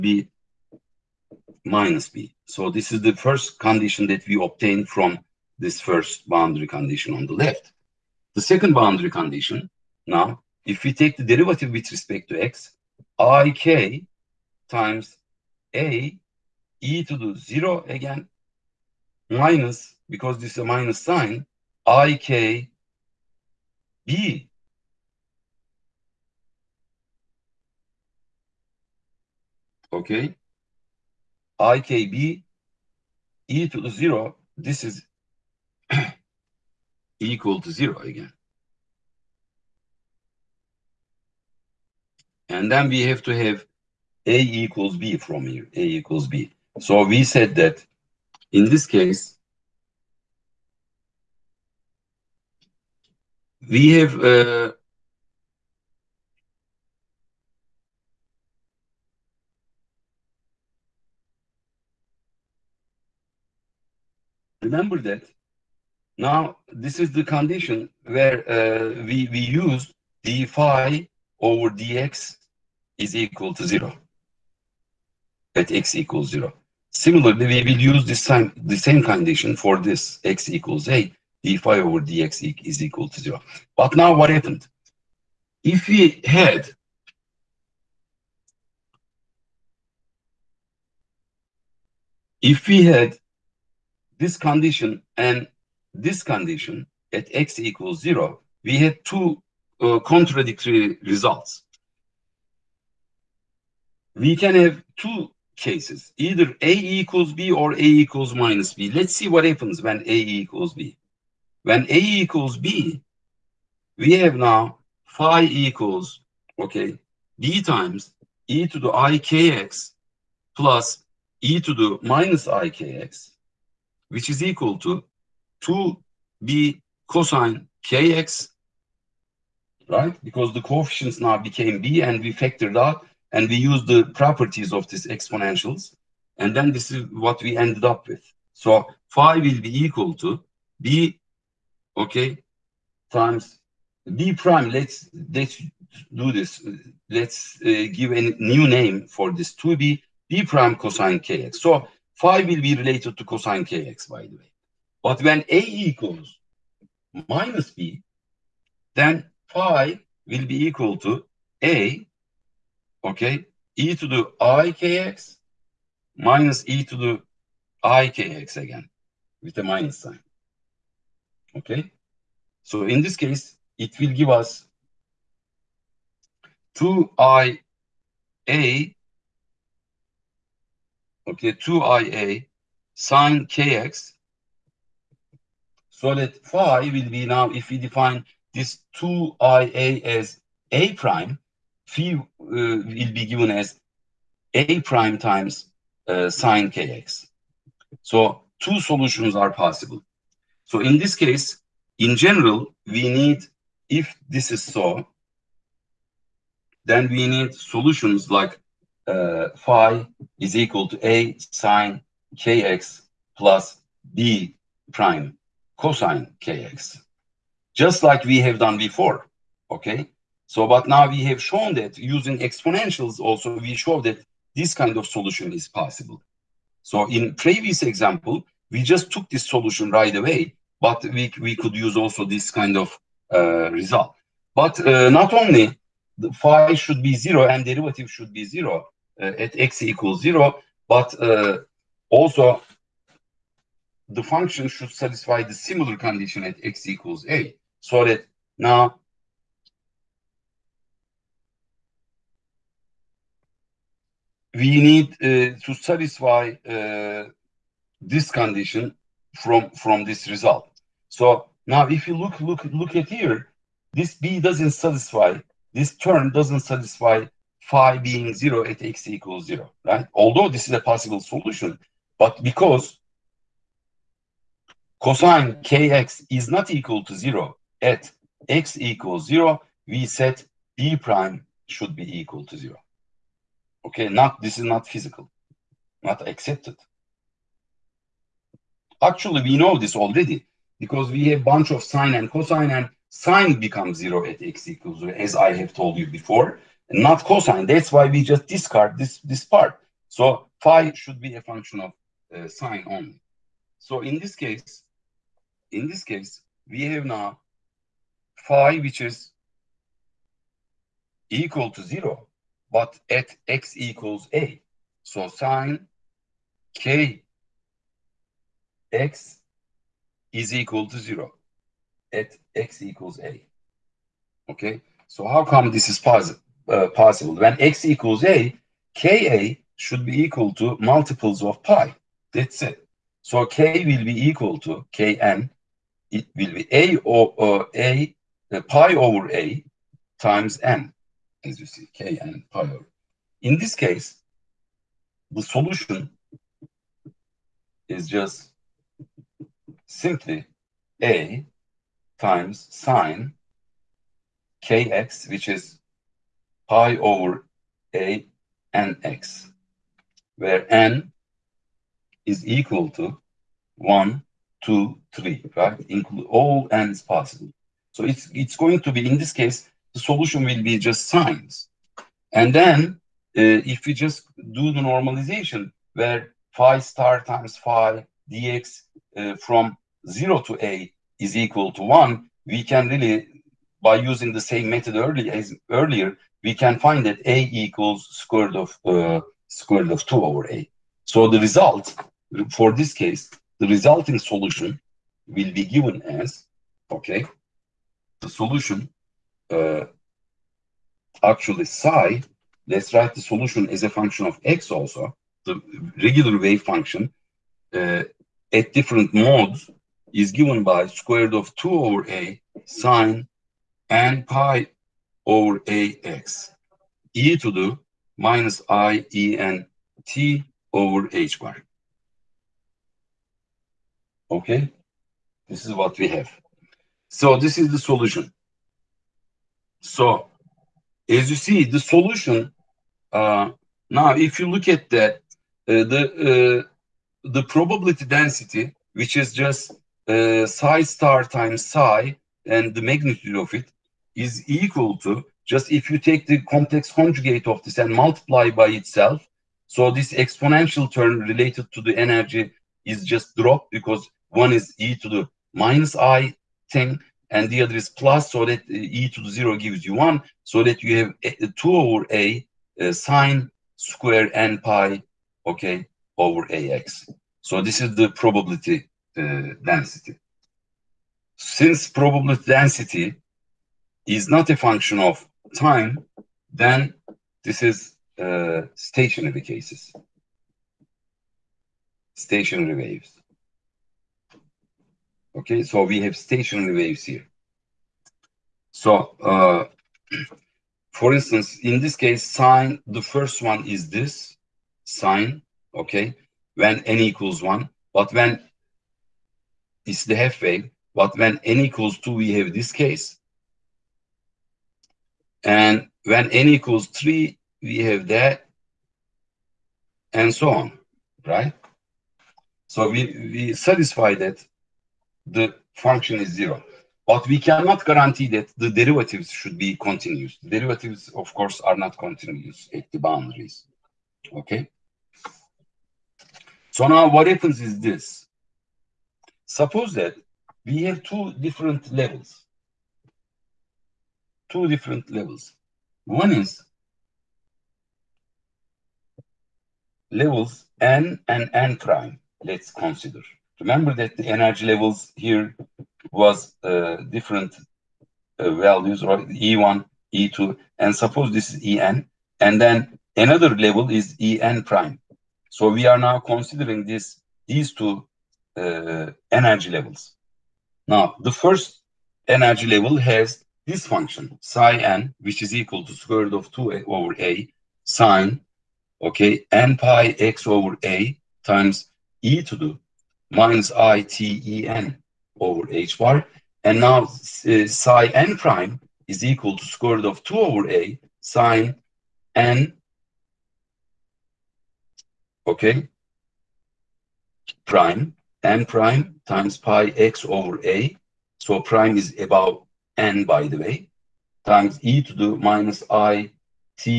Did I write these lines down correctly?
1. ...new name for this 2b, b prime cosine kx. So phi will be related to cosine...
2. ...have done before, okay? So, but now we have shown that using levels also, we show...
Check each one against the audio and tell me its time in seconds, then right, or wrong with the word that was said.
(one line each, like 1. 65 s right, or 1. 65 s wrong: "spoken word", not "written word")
1. 148 s right
2. 218 s wrong: "exponentials", not "levels".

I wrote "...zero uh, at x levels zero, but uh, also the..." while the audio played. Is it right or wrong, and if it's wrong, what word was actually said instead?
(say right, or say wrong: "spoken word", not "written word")
wrong: "equals", not "levels".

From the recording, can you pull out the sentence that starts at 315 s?
So sine k x is equal to 0 at x equals a.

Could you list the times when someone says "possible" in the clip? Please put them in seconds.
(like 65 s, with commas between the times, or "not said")
199 s, 225 s, 270 s, 326 s, 367 s.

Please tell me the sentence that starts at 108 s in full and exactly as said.
Let's see what happens when A equals B.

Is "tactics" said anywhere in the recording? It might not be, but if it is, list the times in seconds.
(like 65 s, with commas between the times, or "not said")
not said.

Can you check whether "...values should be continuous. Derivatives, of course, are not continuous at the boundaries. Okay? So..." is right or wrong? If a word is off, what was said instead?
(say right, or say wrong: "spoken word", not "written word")
wrong: "derivatives", not "values".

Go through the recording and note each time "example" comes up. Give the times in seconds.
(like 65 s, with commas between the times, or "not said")
227 s.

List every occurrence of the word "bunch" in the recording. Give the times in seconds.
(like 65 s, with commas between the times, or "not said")
291 s.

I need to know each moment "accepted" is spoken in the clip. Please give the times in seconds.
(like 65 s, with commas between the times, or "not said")
286 s.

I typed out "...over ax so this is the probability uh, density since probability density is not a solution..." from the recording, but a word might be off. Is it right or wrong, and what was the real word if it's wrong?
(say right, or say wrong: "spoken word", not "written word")
wrong: "function", not "solution".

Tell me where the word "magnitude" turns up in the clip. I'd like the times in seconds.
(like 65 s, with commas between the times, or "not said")
442 s.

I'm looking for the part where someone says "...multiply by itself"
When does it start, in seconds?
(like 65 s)
447 s.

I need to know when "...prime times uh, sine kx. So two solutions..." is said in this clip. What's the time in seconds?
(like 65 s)
194 s.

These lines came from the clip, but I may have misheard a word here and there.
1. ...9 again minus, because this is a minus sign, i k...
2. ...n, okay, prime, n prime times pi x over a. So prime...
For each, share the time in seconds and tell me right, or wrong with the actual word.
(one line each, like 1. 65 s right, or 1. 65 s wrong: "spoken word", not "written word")
1. 17 s wrong: "0", not "9"
2. 582 s right.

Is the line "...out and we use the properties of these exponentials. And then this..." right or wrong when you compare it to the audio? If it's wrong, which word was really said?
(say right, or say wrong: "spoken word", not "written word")
right.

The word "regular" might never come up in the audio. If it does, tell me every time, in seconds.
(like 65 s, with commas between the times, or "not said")
406 s.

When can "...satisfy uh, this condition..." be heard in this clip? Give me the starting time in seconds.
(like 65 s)
255 s.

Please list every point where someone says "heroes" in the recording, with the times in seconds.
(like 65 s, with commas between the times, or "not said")
not said.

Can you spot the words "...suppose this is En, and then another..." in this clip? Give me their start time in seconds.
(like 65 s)
550 s.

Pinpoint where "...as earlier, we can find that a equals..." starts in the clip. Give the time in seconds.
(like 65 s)
385 s.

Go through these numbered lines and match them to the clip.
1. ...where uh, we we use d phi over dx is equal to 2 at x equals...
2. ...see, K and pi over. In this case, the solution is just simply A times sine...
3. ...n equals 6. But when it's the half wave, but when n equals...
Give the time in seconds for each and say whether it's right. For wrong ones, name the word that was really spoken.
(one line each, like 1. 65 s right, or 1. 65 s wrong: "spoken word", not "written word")
1. 68 s wrong: "0", not "2"
2. 341 s right
3. 496 s wrong: "1", not "6".